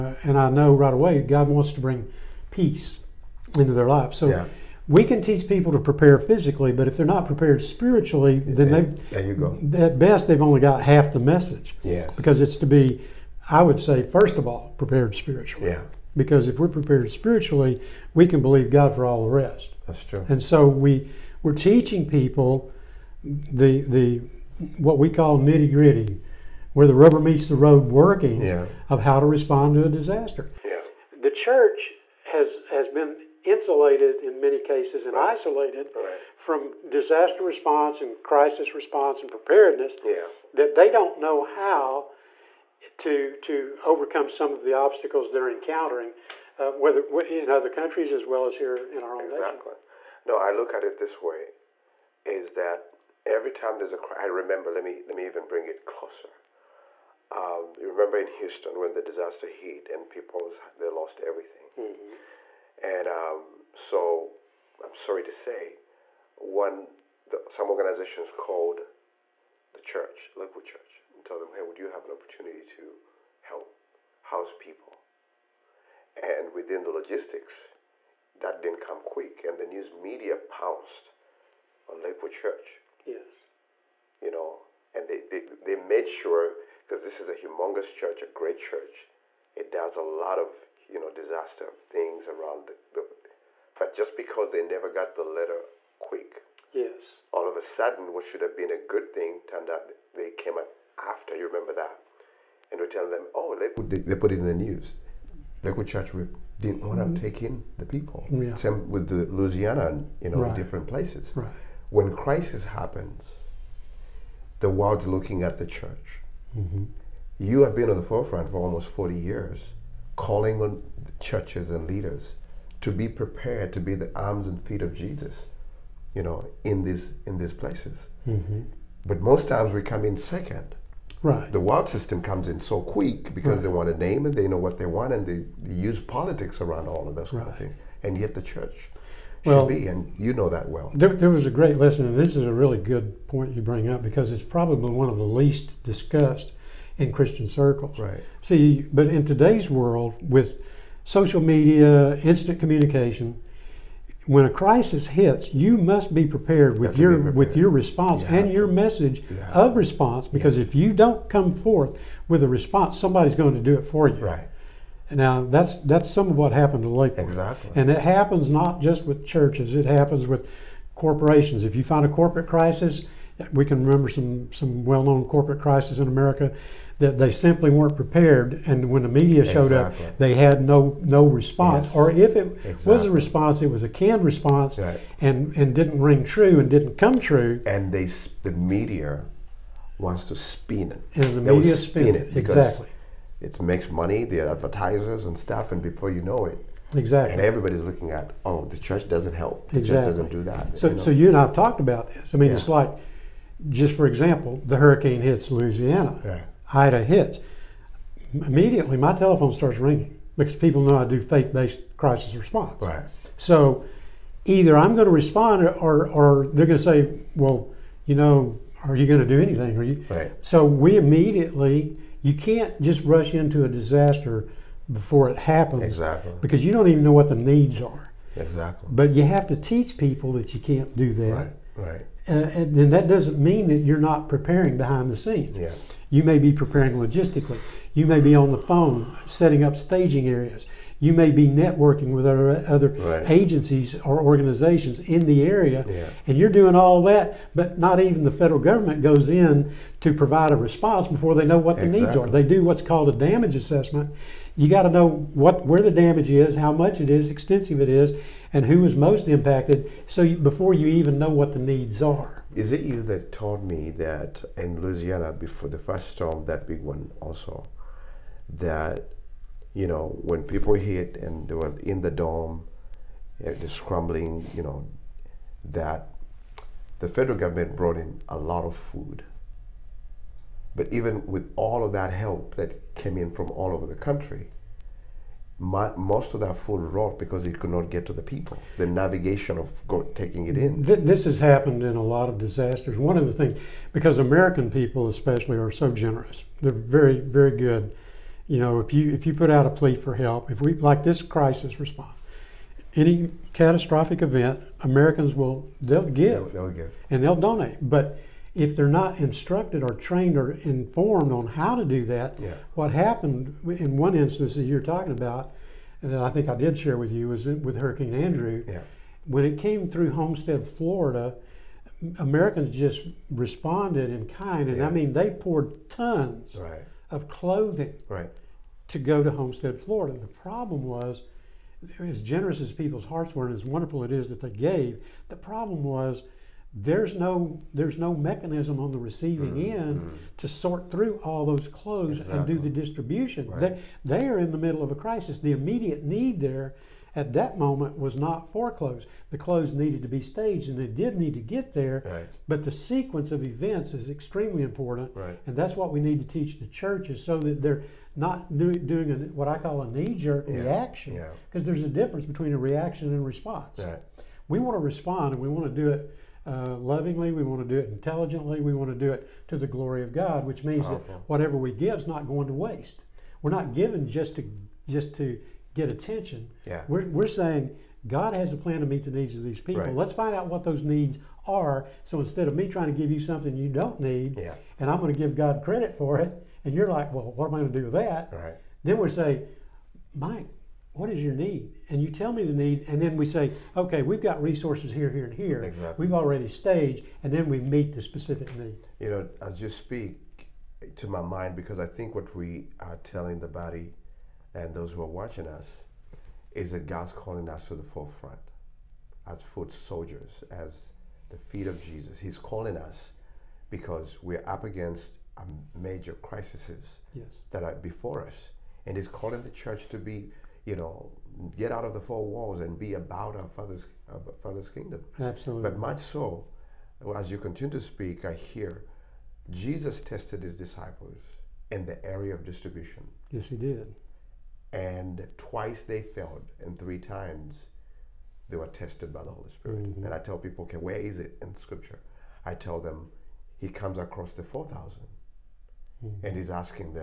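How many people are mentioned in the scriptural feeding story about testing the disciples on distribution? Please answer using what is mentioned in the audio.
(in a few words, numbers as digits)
4,000.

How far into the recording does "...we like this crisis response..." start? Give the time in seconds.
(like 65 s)
300 s.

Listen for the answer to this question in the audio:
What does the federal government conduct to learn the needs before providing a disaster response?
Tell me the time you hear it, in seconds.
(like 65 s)
253 s.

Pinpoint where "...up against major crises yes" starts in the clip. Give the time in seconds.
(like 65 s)
414 s.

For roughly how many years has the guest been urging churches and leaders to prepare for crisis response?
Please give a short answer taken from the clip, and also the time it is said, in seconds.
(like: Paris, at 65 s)
40 years, at 118 s.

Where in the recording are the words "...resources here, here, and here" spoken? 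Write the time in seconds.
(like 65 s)
394 s.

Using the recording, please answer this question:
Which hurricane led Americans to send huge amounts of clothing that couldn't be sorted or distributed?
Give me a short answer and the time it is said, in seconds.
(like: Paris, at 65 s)
Hurricane Andrew, at 317 s.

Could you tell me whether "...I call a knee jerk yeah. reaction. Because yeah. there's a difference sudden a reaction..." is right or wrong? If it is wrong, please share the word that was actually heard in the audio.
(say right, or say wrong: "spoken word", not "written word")
wrong: "between", not "sudden".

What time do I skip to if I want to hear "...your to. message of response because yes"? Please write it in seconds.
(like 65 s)
158 s.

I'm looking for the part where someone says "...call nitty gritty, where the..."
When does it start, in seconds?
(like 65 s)
25 s.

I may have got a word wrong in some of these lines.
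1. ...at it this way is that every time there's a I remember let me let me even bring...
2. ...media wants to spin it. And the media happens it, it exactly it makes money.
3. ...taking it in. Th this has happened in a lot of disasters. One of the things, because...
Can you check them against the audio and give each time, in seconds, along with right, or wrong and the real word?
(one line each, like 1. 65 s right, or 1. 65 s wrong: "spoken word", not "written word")
1. 50 s right
2. 188 s wrong: "spins", not "happens"
3. 290 s right.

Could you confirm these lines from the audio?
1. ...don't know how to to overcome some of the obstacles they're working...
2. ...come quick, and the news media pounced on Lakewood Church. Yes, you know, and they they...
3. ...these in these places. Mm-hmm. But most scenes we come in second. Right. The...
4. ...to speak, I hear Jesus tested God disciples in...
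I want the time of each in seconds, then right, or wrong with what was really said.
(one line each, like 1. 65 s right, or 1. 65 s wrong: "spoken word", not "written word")
1. 40 s wrong: "encountering", not "working"
2. 78 s right
3. 126 s wrong: "times", not "scenes"
4. 427 s wrong: "His", not "God".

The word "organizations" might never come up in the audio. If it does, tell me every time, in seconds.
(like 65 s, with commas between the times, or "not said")
67 s, 244 s.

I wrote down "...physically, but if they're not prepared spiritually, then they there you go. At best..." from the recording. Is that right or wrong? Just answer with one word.
right.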